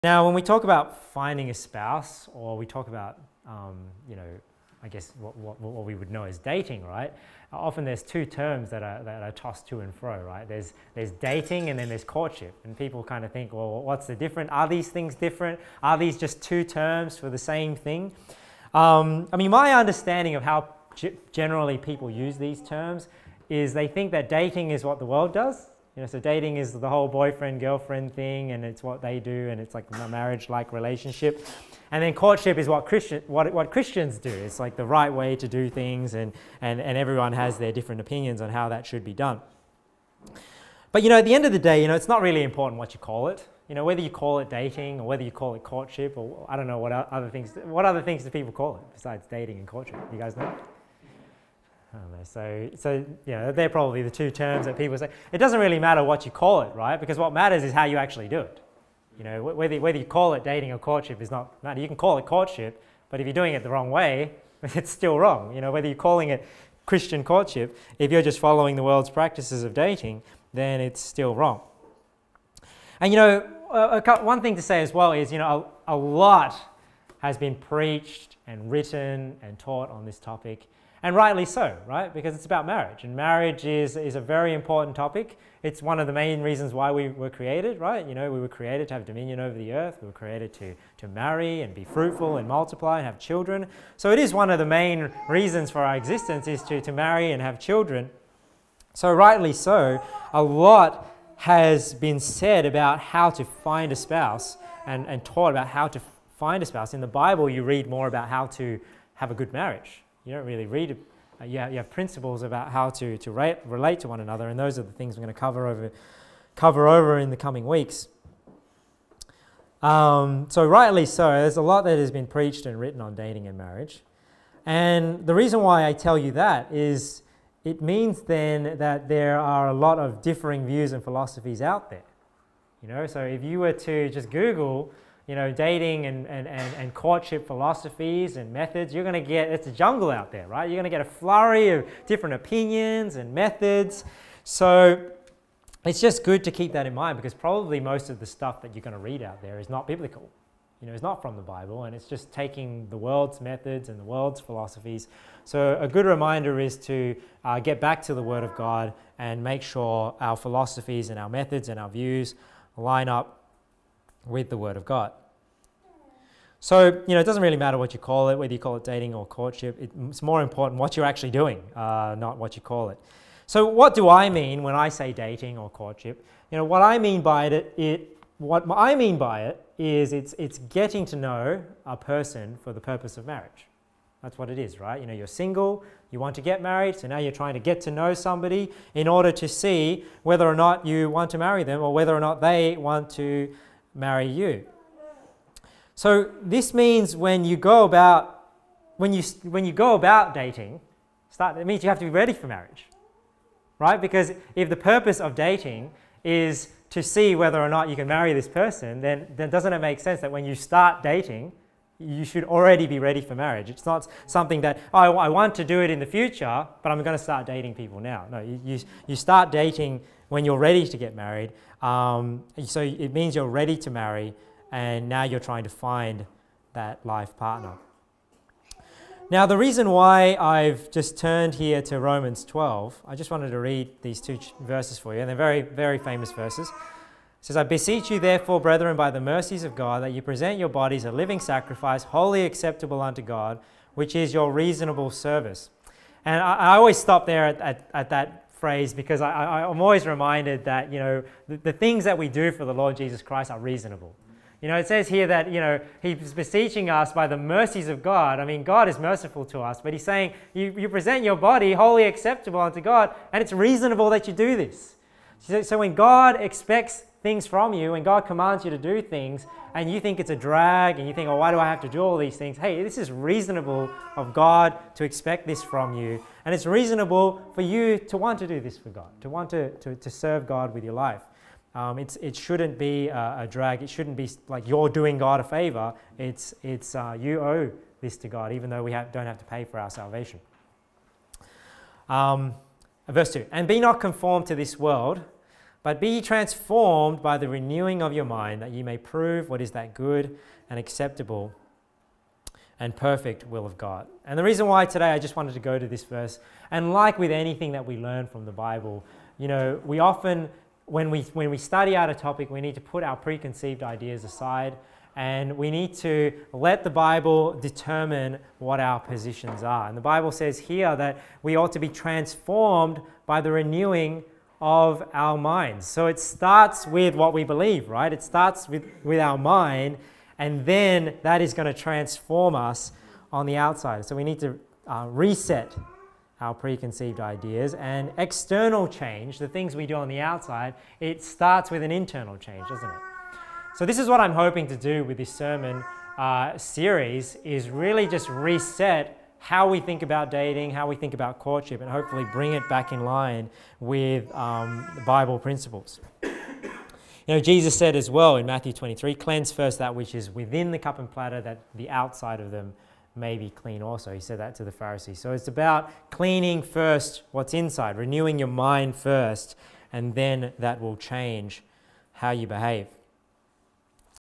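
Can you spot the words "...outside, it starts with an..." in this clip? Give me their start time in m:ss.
5:40.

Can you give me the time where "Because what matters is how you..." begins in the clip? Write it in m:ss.
0:56.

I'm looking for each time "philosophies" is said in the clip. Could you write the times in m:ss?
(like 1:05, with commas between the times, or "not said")
2:11, 2:17, 2:34, 2:40.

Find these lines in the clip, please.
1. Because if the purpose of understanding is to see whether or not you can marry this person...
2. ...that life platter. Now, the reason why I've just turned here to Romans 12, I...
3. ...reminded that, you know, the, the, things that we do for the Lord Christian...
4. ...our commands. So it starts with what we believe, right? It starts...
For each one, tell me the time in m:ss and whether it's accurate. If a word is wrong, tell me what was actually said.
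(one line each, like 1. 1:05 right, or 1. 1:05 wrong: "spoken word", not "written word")
1. 3:23 wrong: "dating", not "understanding"
2. 3:46 wrong: "partner", not "platter"
3. 4:10 wrong: "Jesus", not "Christian"
4. 5:25 wrong: "minds", not "commands".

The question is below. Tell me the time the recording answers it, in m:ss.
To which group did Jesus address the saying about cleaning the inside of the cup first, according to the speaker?
6:04.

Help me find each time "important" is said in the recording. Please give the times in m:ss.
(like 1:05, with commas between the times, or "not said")
0:42, 1:24, 2:50.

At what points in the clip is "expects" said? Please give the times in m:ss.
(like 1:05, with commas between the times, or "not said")
4:26, 4:35.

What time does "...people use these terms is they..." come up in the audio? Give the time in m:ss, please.
0:21.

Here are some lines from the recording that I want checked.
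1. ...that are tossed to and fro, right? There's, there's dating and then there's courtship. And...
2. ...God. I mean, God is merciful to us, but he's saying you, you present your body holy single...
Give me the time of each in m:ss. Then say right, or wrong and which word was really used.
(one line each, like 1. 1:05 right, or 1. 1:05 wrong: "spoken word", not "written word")
1. 0:09 right
2. 4:18 wrong: "acceptable", not "single".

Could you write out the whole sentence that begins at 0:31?
And then courtship is what Christian what, what Christians do.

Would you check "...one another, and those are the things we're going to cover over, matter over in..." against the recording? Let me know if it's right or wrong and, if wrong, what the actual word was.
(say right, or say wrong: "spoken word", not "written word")
wrong: "cover", not "matter".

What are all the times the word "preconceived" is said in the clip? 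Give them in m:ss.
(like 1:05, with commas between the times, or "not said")
5:13, 5:36.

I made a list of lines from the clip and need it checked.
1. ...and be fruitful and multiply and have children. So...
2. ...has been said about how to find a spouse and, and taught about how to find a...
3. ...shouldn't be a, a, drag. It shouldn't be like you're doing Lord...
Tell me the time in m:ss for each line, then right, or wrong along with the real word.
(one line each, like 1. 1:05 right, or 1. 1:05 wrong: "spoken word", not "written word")
1. 1:31 right
2. 1:41 right
3. 4:42 wrong: "God", not "Lord".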